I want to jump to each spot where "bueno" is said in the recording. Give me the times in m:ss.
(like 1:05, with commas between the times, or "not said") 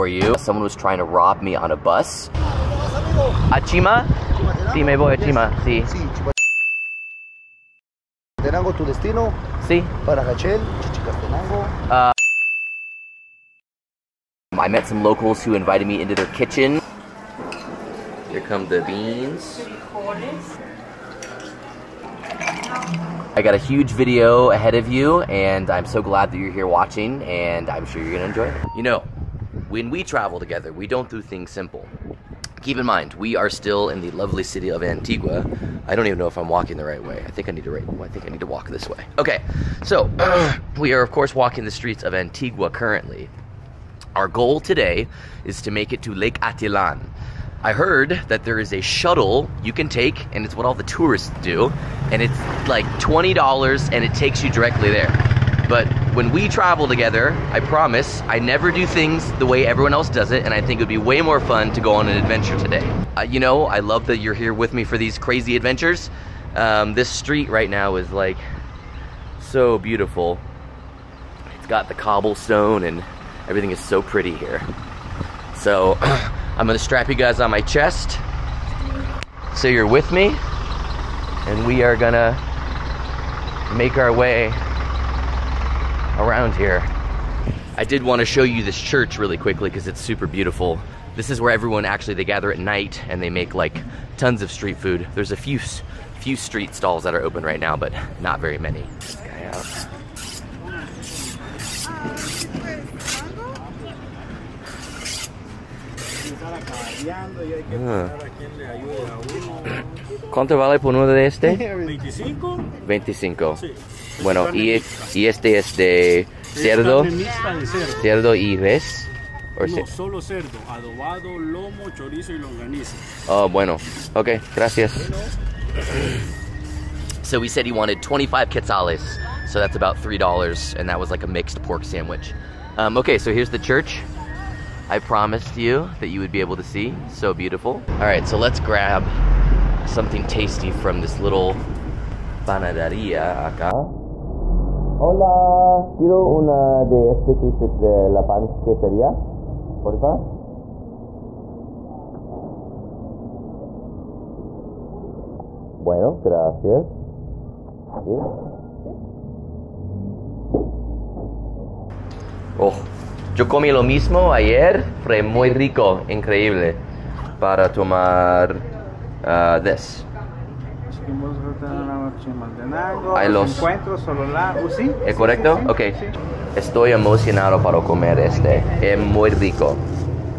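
1:54, 2:03, 2:35.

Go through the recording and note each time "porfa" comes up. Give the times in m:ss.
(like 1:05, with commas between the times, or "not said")
2:29.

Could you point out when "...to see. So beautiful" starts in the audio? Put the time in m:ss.
2:16.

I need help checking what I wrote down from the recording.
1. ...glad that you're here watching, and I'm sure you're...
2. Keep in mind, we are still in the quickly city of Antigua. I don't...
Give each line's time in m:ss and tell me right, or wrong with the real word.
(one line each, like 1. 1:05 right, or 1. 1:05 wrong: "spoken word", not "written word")
1. 0:26 right
2. 0:32 wrong: "lovely", not "quickly".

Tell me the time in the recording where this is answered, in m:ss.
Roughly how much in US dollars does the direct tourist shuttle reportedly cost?
0:52.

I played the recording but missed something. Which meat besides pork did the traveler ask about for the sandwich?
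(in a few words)
res.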